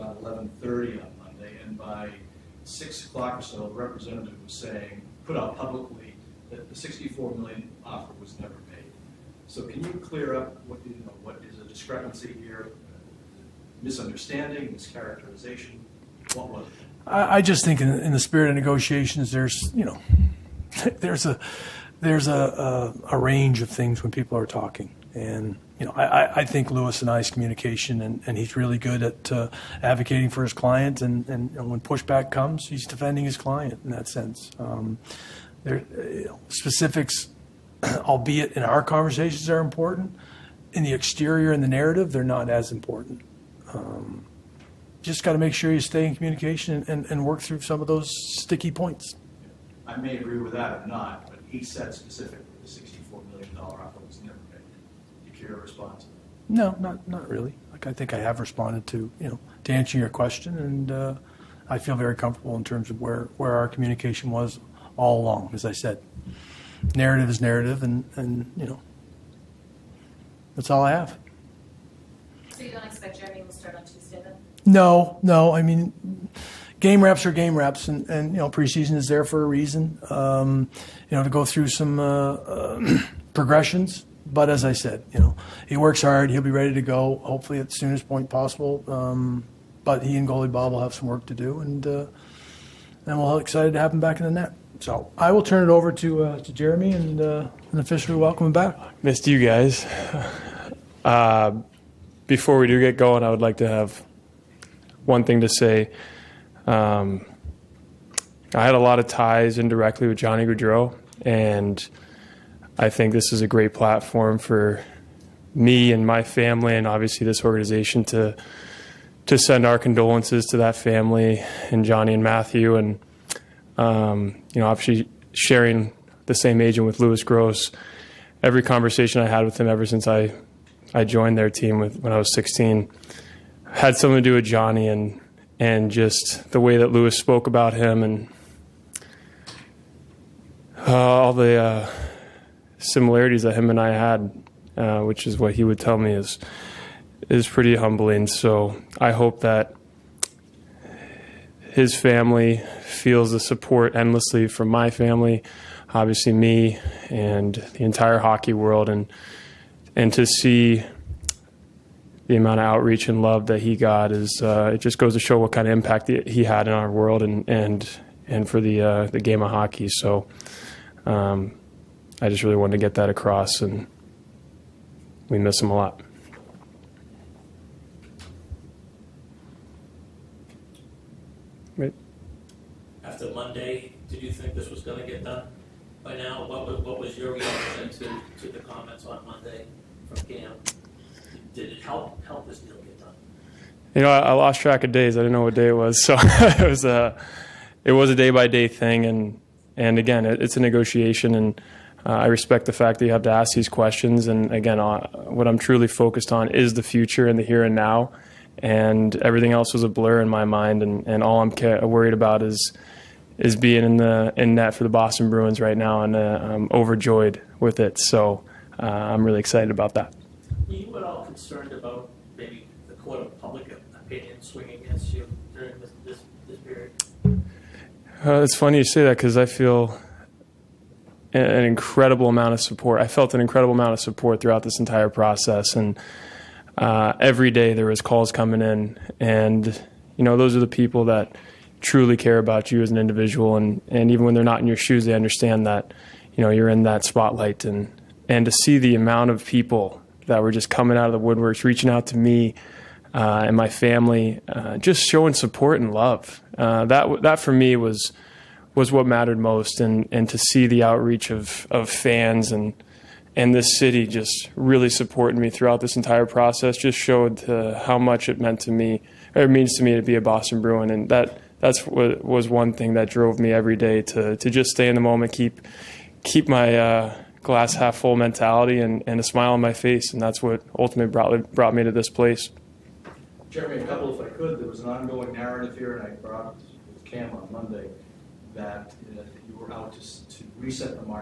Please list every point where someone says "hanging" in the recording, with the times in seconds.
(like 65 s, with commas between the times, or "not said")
not said.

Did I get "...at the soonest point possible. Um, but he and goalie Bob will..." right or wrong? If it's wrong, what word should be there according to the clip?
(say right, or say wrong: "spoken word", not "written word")
right.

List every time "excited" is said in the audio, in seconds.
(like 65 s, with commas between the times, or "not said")
93 s, 219 s.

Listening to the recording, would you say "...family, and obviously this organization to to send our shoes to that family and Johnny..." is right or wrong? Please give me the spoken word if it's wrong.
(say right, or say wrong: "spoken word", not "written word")
wrong: "condolences", not "shoes".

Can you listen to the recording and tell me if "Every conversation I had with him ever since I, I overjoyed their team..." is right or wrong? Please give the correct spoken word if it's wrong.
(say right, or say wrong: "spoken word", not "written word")
wrong: "joined", not "overjoyed".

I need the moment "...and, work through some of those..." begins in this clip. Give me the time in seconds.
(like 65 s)
47 s.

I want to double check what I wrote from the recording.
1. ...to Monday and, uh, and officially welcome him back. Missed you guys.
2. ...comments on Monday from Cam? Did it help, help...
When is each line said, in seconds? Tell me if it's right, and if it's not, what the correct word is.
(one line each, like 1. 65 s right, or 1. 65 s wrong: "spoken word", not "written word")
1. 96 s wrong: "Jeremy", not "Monday"
2. 188 s right.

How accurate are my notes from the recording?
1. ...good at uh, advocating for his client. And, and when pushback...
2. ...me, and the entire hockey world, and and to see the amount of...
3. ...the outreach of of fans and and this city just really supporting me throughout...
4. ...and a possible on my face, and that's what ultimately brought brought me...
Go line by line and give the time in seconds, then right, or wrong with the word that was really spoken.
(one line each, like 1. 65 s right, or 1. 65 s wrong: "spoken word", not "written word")
1. 28 s right
2. 156 s right
3. 260 s right
4. 279 s wrong: "smile", not "possible".